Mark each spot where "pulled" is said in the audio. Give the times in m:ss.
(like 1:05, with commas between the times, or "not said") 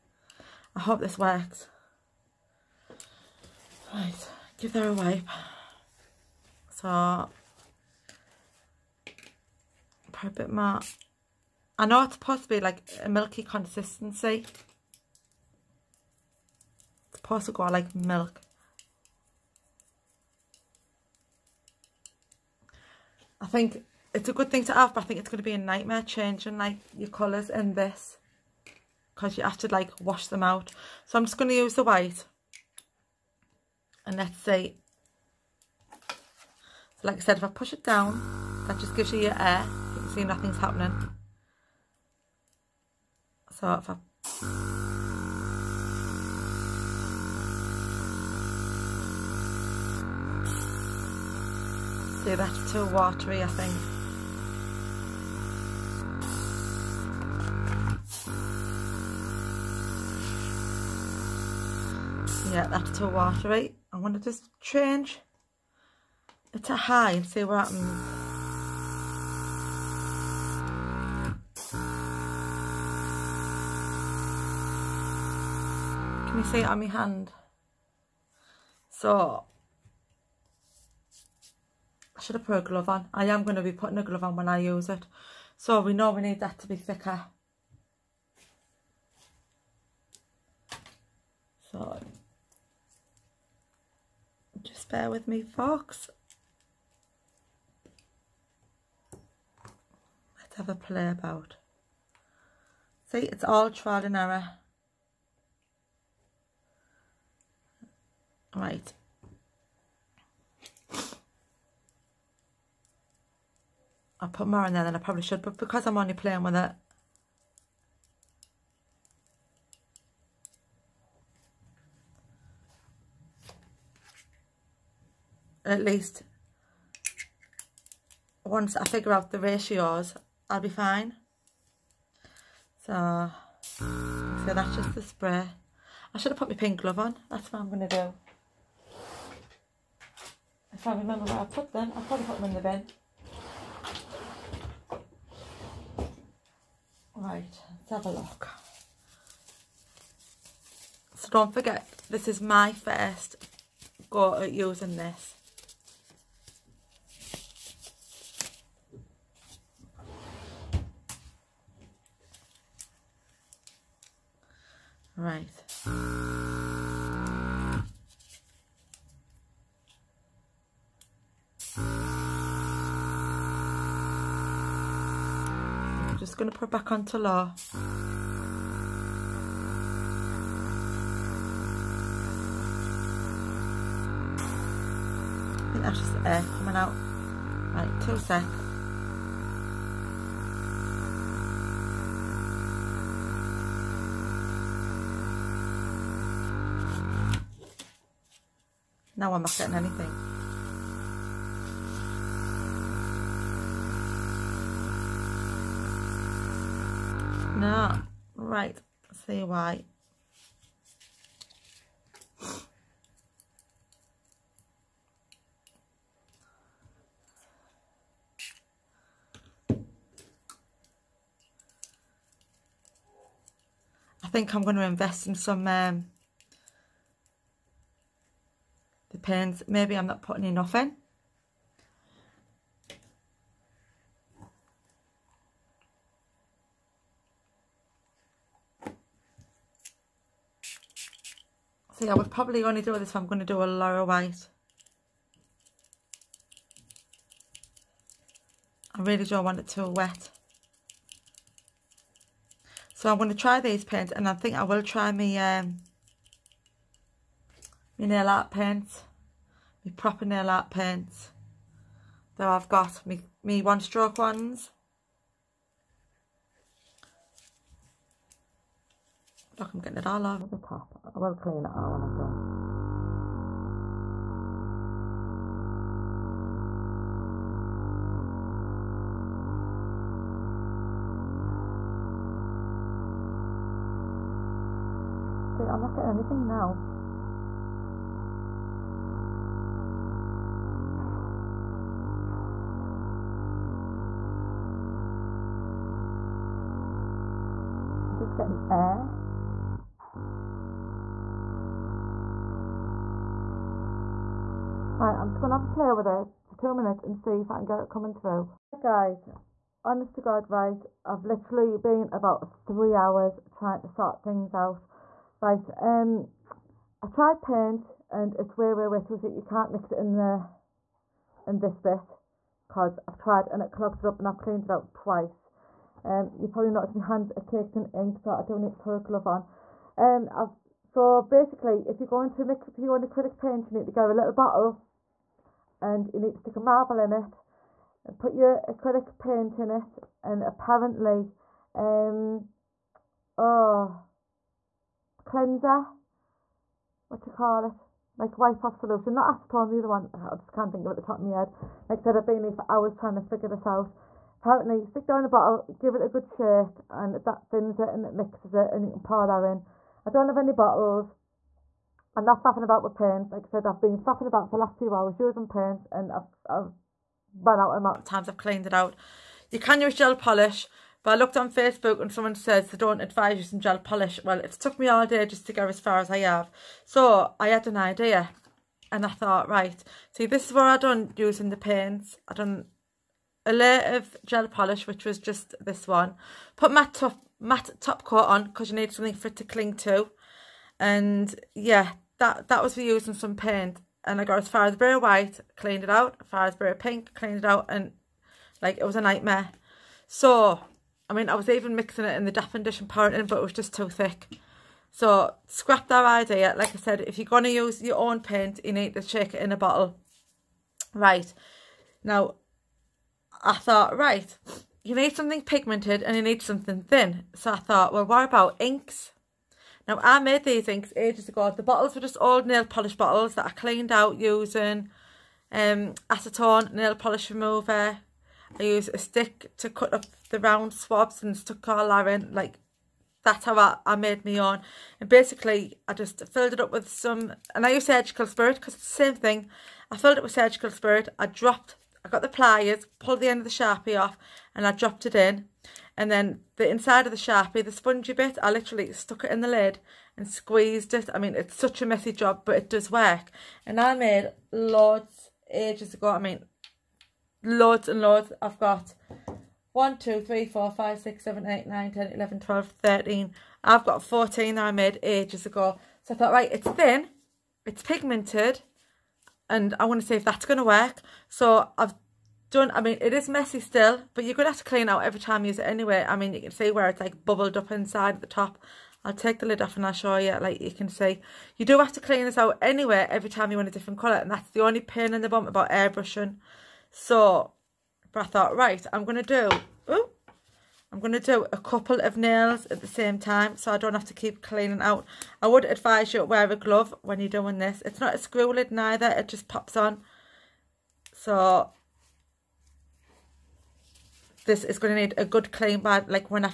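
7:23.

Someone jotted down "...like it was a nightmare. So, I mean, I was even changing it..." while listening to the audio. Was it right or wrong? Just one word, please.
wrong.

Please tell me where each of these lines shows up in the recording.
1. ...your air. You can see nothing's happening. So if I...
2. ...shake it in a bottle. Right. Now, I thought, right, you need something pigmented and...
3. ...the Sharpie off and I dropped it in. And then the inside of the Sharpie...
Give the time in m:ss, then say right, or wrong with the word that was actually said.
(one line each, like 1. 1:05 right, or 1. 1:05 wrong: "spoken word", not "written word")
1. 0:39 right
2. 6:49 right
3. 7:23 right.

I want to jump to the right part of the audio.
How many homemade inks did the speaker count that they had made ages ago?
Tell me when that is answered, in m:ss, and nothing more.
7:44.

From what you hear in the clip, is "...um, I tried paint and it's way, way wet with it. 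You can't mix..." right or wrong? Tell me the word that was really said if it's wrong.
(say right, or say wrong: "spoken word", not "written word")
right.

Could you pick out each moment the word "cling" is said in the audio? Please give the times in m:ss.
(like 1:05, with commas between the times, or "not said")
6:29.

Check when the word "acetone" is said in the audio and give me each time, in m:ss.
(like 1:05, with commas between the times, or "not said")
5:49, 7:06.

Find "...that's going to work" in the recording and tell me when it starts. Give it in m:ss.
7:50.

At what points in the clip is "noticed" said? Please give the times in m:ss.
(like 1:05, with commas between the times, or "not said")
5:26.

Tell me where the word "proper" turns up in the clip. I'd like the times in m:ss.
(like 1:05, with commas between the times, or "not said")
4:19.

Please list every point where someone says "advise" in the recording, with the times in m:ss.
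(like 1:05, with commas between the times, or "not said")
6:13, 8:15.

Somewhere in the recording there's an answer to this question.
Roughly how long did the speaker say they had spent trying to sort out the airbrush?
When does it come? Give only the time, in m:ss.
5:12.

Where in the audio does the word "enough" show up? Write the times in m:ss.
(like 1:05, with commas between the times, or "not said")
3:50.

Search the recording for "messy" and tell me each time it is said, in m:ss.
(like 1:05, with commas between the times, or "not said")
7:31, 7:53.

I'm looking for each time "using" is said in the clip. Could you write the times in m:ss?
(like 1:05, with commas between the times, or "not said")
2:34, 6:05, 6:13, 6:21, 6:32, 7:04.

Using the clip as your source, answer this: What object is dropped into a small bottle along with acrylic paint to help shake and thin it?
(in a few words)
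A marble.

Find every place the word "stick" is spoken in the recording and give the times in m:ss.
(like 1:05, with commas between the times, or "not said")
5:36, 5:54, 7:08.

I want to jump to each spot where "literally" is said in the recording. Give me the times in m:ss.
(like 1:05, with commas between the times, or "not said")
5:11, 7:28.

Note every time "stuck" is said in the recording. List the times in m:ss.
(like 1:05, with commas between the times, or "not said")
7:11, 7:28.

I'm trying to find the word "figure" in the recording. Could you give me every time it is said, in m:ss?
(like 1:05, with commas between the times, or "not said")
2:08, 5:53.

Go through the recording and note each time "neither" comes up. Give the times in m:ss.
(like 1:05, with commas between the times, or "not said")
8:18.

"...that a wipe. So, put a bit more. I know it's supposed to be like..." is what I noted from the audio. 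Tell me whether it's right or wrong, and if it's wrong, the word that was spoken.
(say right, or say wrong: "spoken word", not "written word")
right.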